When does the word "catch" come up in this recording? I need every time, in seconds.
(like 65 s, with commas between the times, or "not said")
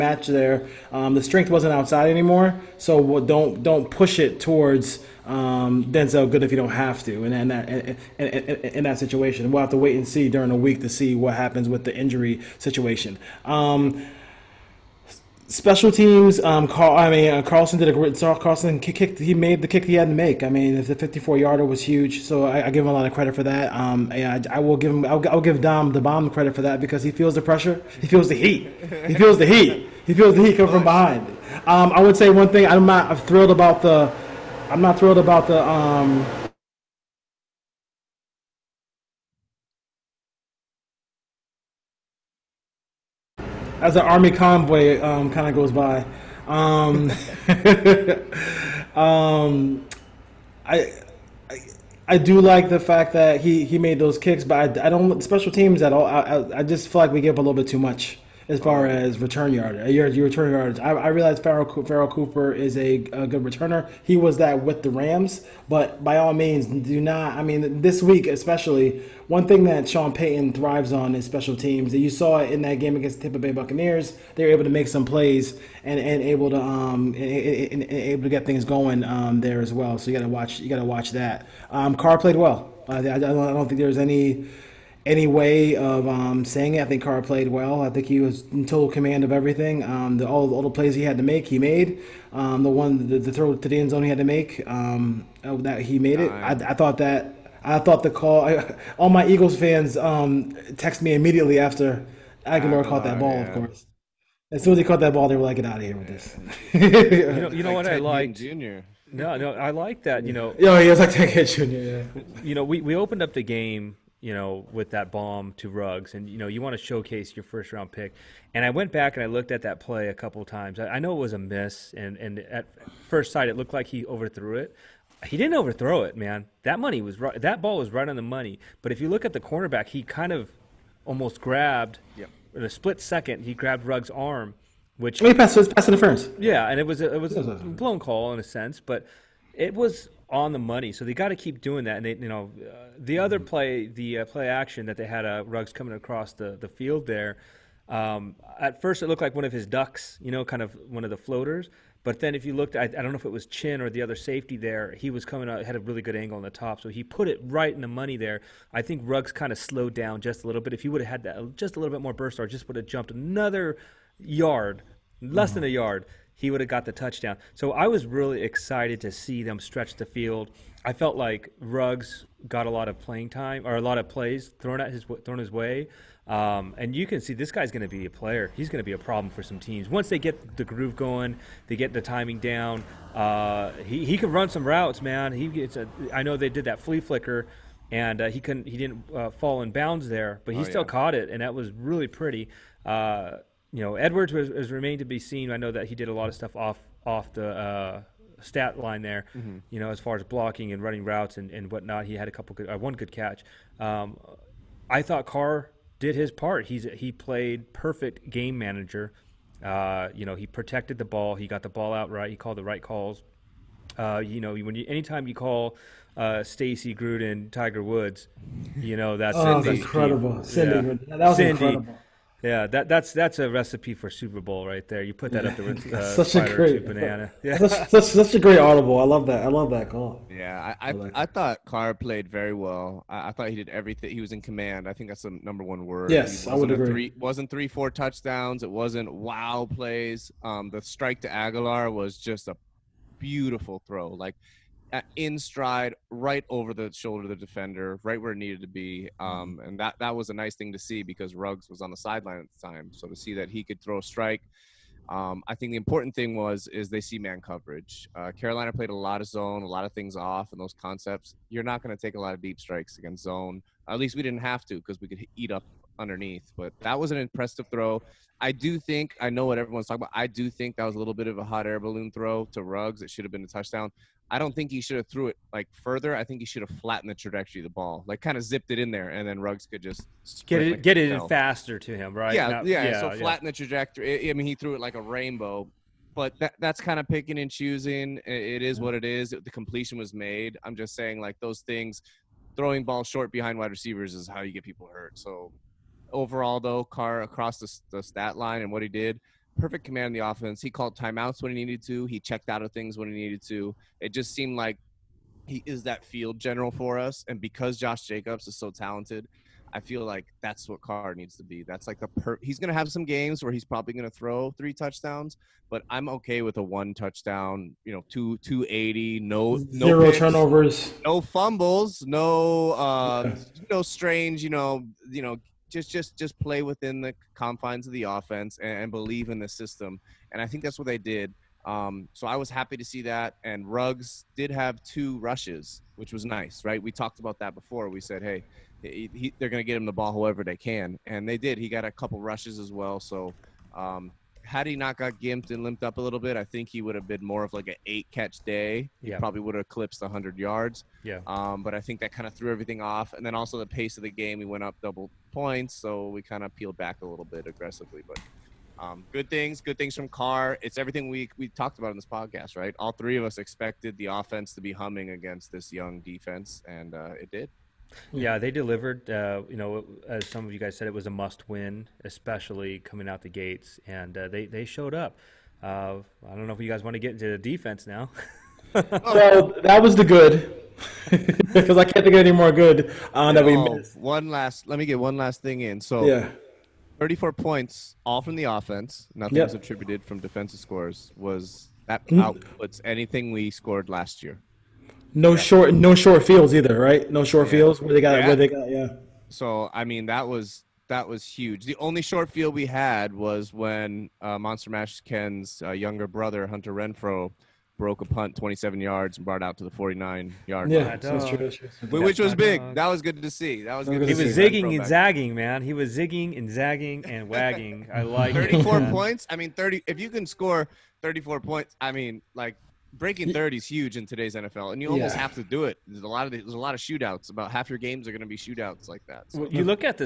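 203 s, 348 s.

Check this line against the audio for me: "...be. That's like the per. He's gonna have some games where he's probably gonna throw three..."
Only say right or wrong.
right.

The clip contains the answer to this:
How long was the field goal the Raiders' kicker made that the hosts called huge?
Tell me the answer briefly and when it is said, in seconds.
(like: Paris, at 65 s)
54 yards, at 20 s.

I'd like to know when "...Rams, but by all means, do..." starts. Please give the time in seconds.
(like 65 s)
64 s.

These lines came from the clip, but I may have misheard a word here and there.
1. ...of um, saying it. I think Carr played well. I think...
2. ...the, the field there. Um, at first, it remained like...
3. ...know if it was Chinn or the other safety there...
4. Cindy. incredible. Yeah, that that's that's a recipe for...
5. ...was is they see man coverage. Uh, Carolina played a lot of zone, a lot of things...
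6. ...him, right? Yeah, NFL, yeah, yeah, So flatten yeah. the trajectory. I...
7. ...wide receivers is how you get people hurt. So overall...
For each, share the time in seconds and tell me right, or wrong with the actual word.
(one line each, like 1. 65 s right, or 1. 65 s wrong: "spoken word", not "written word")
1. 85 s right
2. 146 s wrong: "looked", not "remained"
3. 153 s right
4. 221 s right
5. 256 s right
6. 281 s wrong: "Not", not "NFL"
7. 293 s right.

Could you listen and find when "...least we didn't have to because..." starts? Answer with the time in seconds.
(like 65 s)
263 s.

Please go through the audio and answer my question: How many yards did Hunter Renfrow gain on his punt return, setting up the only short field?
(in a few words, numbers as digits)
27 yards.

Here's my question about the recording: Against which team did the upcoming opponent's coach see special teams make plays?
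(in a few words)
Tampa Bay Buccaneers.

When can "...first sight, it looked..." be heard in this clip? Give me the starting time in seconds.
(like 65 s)
123 s.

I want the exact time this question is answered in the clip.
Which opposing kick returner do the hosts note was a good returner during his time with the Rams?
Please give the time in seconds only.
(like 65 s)
61 s.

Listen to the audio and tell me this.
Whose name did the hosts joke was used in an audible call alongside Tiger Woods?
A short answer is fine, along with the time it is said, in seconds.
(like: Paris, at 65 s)
Stacy Gruden, at 216 s.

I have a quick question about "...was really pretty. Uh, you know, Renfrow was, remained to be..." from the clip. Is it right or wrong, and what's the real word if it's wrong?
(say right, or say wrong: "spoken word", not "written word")
wrong: "Edwards", not "Renfrow".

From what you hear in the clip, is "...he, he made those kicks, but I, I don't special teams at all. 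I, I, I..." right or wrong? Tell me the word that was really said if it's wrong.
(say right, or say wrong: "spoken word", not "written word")
right.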